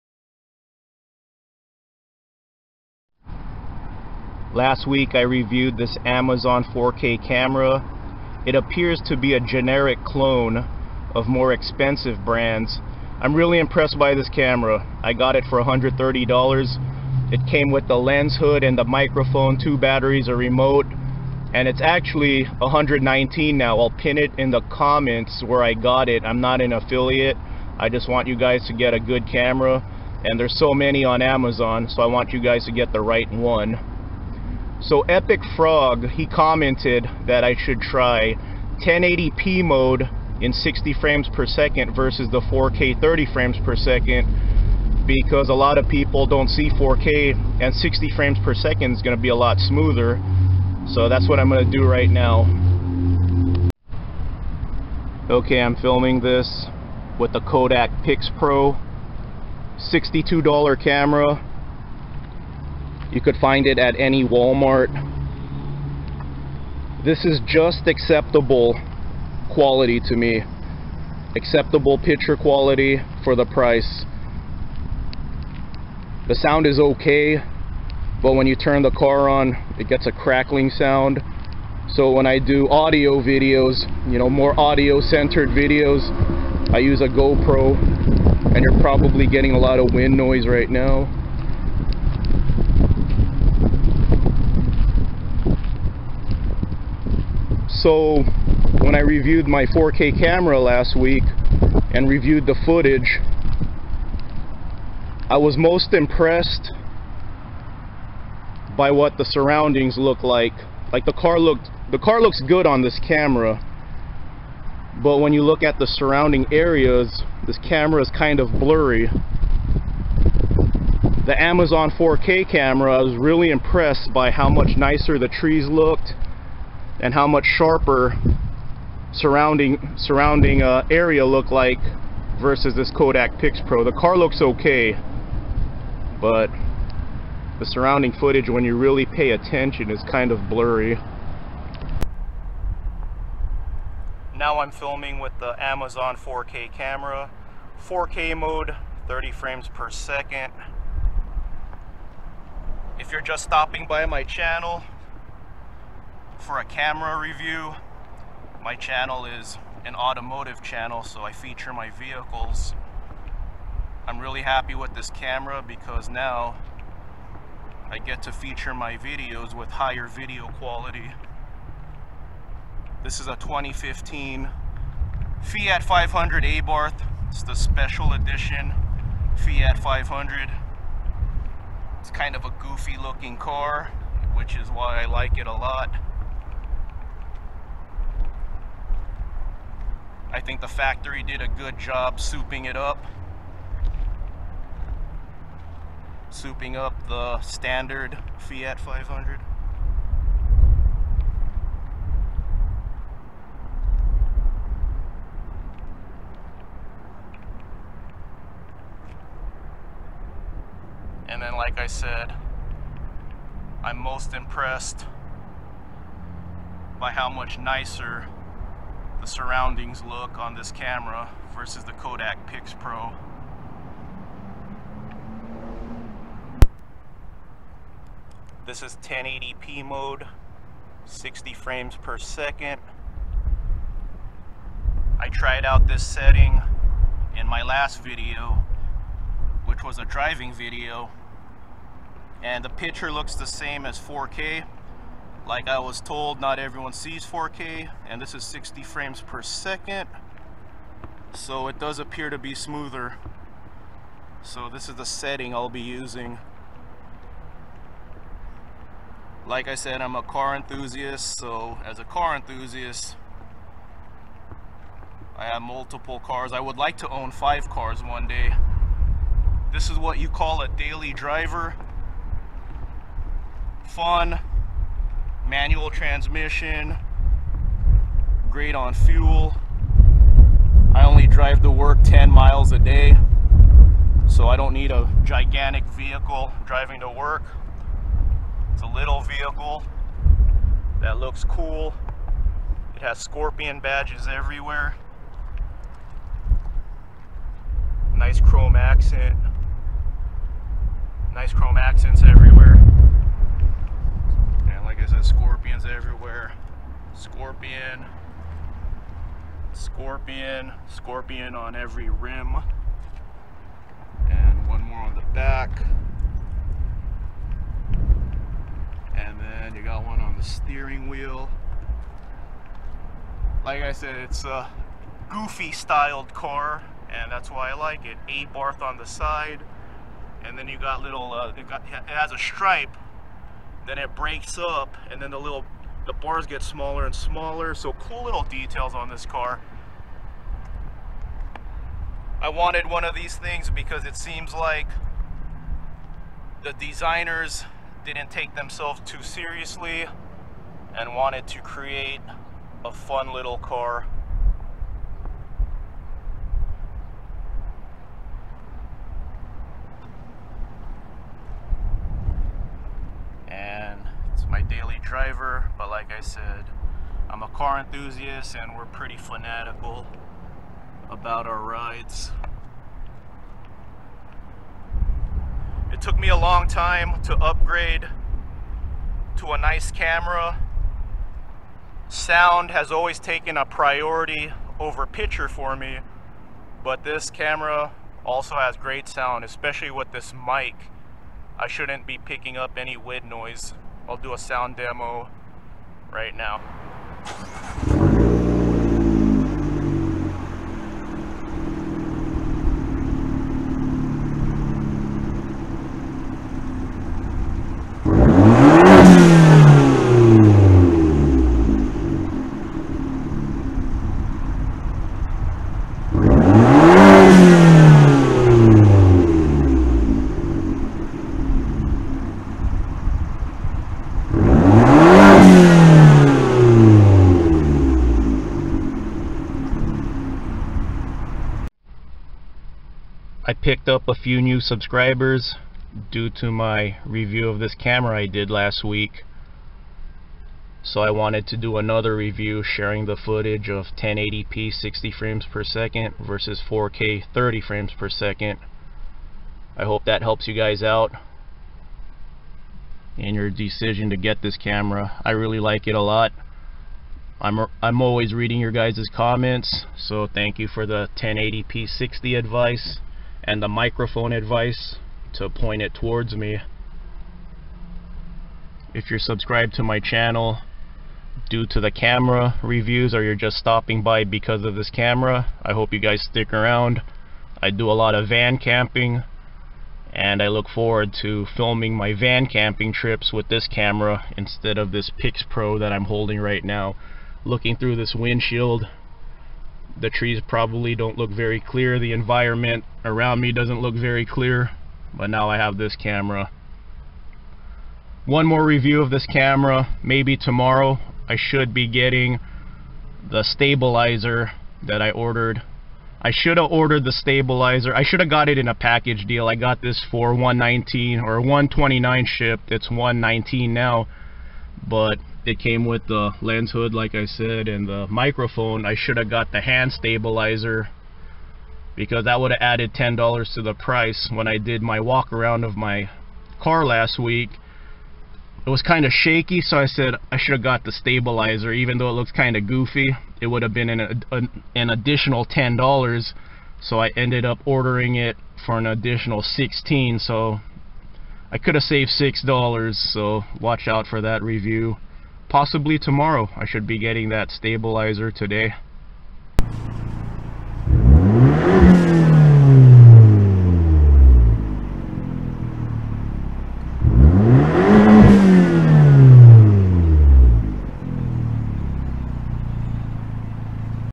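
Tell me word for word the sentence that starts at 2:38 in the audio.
My channel is an automotive channel, so I feature my vehicles.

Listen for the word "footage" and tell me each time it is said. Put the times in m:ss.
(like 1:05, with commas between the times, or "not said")
1:42, 2:18, 7:23.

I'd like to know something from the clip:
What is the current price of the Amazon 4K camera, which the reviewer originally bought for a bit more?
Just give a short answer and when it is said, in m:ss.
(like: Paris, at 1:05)
$119, at 0:22.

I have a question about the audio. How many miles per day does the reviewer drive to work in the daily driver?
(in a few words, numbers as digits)
10.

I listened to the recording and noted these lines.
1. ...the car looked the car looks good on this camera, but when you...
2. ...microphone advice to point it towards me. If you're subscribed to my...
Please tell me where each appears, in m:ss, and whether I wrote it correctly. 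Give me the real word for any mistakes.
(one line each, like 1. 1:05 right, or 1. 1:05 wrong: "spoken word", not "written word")
1. 1:51 right
2. 7:43 right.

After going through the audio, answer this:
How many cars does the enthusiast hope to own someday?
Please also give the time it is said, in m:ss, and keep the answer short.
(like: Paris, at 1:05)
5, at 4:27.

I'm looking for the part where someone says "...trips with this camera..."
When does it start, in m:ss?
8:02.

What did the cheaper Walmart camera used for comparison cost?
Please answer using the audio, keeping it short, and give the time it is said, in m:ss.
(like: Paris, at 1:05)
$62, at 0:59.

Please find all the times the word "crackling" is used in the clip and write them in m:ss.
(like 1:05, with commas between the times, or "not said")
1:20.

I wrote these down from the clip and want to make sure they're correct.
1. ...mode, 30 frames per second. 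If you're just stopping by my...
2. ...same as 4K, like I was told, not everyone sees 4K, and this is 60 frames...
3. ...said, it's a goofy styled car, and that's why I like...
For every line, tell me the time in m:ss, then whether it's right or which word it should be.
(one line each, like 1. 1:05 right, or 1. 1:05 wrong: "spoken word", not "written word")
1. 2:28 right
2. 4:03 right
3. 5:23 right.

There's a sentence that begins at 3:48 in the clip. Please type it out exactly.
This is 1080p mode, 60 frames per second.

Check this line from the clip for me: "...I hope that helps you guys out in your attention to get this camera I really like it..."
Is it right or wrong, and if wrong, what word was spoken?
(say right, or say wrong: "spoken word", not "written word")
wrong: "decision", not "attention".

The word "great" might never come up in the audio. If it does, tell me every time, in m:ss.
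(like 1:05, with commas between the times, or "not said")
4:38, 6:28.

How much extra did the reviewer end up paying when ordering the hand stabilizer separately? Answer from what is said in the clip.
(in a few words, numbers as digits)
$16.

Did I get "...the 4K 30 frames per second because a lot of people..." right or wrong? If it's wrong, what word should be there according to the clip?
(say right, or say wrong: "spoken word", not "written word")
right.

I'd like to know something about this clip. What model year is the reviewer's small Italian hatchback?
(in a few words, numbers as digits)
2015.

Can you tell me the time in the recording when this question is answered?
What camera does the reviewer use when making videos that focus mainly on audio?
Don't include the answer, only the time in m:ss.
1:27.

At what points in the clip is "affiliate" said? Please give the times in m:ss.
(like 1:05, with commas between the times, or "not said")
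0:26.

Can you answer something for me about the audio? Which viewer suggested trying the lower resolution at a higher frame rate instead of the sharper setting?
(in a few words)
Epic Frog.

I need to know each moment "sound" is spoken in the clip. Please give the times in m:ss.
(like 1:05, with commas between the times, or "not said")
1:16, 1:20, 6:22, 6:29, 6:34.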